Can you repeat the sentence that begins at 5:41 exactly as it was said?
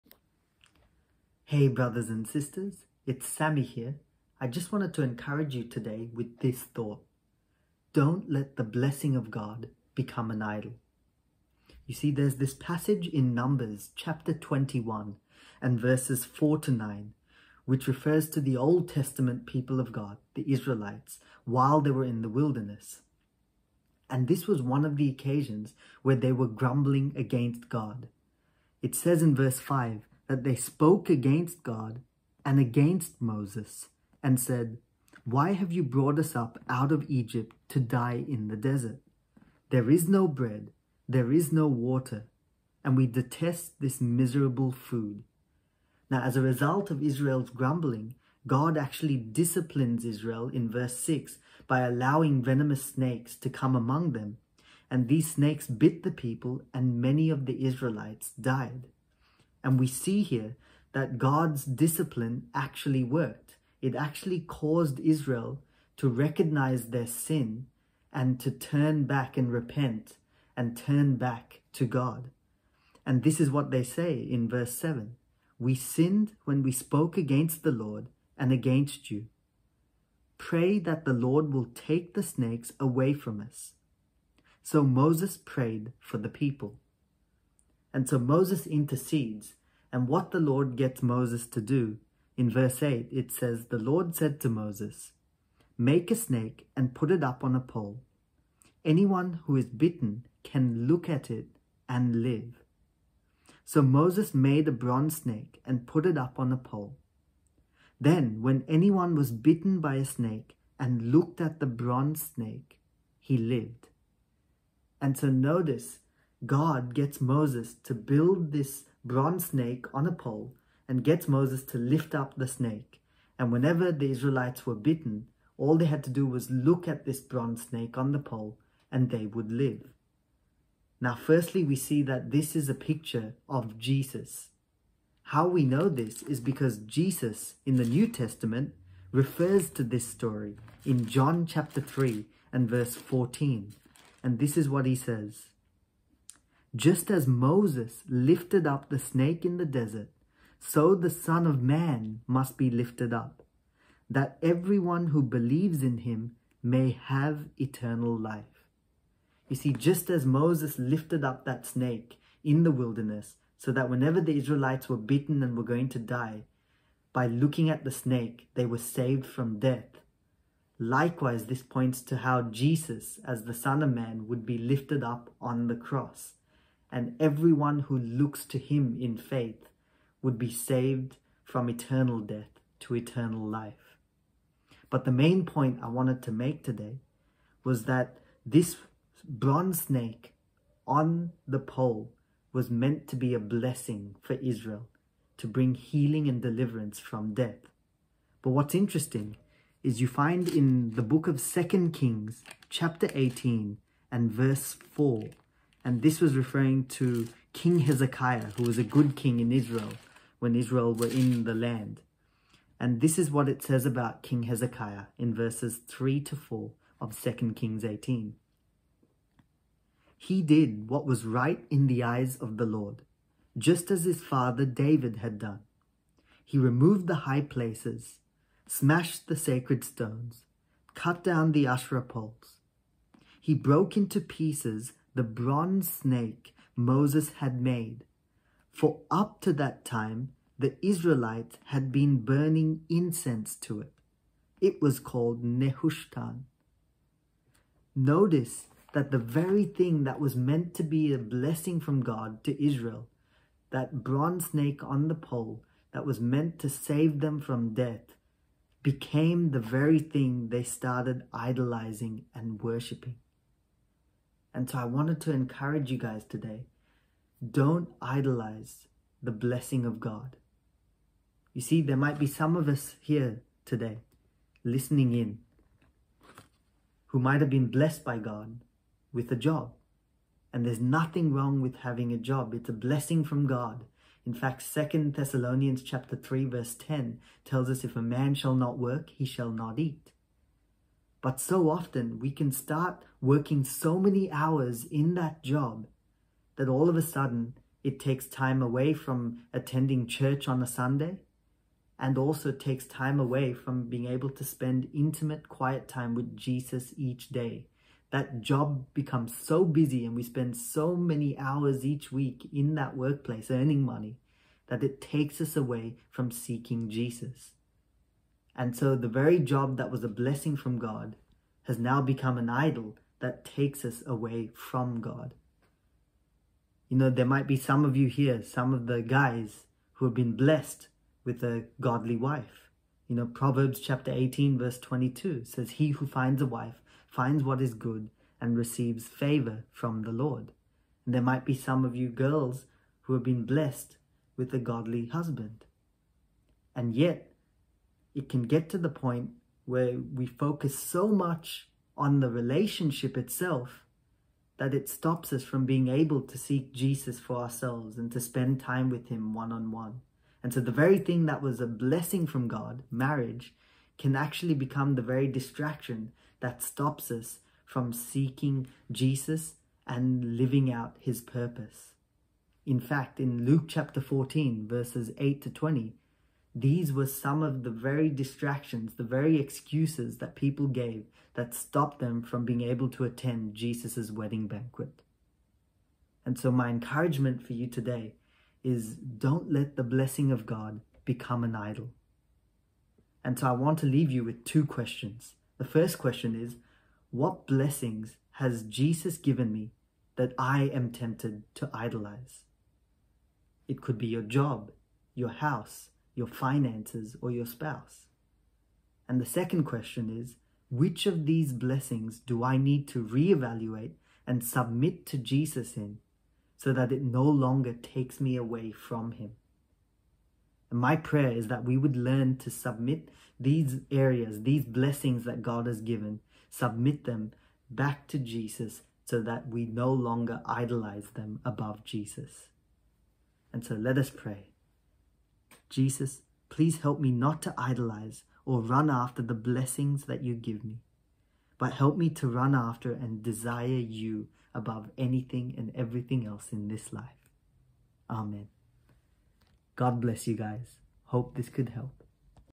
And there might be some of you girls who have been blessed with a godly husband.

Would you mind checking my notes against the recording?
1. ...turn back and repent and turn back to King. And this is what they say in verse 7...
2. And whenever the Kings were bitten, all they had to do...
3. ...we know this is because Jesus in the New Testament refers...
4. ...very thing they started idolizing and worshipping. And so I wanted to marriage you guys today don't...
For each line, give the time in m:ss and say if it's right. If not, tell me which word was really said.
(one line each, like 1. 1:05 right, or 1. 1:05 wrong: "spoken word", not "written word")
1. 1:08 wrong: "God", not "King"
2. 2:03 wrong: "Israelites", not "Kings"
3. 2:15 right
4. 4:19 wrong: "encourage", not "marriage".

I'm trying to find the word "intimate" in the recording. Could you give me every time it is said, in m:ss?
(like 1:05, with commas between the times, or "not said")
5:04.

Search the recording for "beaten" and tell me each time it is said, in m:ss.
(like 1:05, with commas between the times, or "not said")
2:44.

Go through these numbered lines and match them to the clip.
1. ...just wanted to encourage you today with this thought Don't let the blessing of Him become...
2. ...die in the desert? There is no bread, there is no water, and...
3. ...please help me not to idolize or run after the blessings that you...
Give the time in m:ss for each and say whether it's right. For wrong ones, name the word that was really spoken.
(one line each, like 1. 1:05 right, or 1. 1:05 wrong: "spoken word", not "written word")
1. 0:04 wrong: "God", not "Him"
2. 0:37 right
3. 7:16 right.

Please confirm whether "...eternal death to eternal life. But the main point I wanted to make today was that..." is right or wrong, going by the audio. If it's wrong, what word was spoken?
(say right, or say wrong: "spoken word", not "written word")
right.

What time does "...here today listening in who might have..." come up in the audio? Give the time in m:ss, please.
4:33.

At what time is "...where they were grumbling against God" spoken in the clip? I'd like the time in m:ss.
0:26.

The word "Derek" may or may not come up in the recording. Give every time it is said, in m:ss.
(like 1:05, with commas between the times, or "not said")
not said.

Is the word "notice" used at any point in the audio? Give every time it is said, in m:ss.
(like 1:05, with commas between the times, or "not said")
1:55, 4:07.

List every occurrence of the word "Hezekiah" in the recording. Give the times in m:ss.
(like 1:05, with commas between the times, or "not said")
3:27, 3:34.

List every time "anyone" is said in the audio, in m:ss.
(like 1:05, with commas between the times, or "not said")
1:38, 1:48.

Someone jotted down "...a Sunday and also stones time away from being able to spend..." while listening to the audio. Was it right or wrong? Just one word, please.
wrong.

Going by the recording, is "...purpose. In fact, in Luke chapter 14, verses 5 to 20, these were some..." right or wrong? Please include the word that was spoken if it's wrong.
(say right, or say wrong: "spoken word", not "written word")
wrong: "8", not "5".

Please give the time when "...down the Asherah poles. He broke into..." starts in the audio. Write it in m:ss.
3:51.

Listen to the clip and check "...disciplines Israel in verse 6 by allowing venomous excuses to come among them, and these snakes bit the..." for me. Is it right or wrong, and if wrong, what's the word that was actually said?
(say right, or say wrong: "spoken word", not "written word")
wrong: "snakes", not "excuses".